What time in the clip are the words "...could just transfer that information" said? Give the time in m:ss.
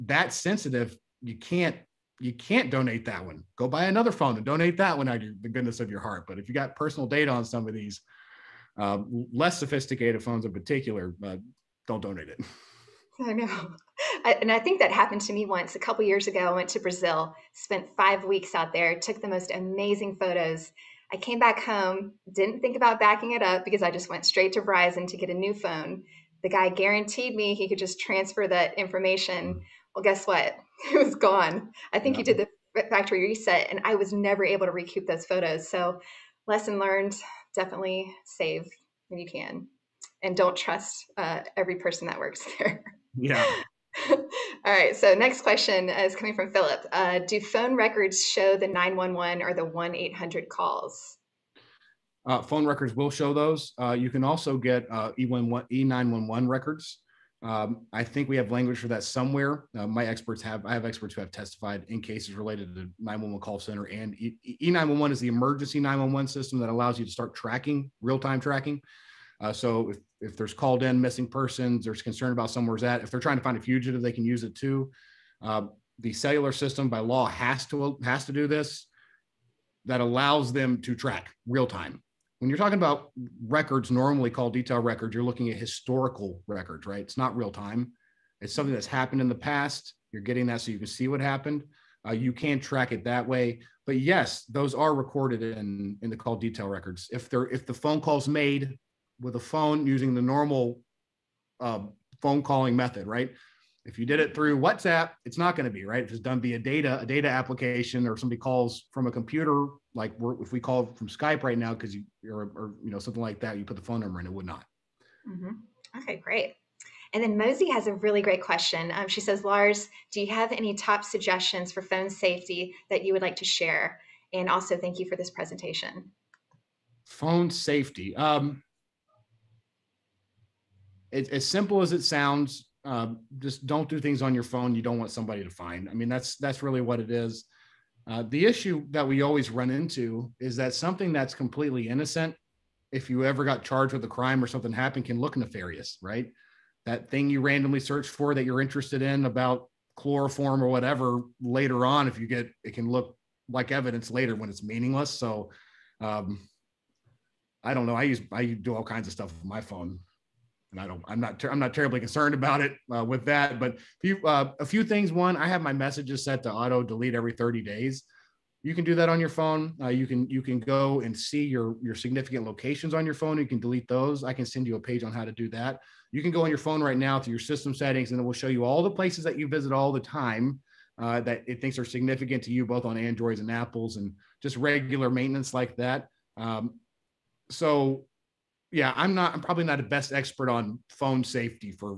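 0:27.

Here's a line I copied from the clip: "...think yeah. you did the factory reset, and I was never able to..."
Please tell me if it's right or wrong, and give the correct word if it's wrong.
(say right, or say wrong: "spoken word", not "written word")
right.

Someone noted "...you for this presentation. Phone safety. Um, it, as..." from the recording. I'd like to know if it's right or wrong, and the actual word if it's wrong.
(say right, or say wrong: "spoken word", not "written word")
right.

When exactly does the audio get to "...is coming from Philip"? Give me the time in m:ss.
0:45.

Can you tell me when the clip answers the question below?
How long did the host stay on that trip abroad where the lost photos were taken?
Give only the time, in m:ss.
0:17.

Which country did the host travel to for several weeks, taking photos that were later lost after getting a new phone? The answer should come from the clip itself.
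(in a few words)
Brazil.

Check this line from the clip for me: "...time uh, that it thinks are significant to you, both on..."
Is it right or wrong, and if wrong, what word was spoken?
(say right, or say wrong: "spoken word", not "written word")
right.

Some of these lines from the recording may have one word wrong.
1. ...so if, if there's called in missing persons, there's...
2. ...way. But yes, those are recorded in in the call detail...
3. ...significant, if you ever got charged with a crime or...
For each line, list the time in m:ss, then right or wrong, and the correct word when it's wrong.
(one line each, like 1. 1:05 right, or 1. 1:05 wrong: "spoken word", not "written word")
1. 1:09 right
2. 1:33 right
3. 2:21 wrong: "innocent", not "significant".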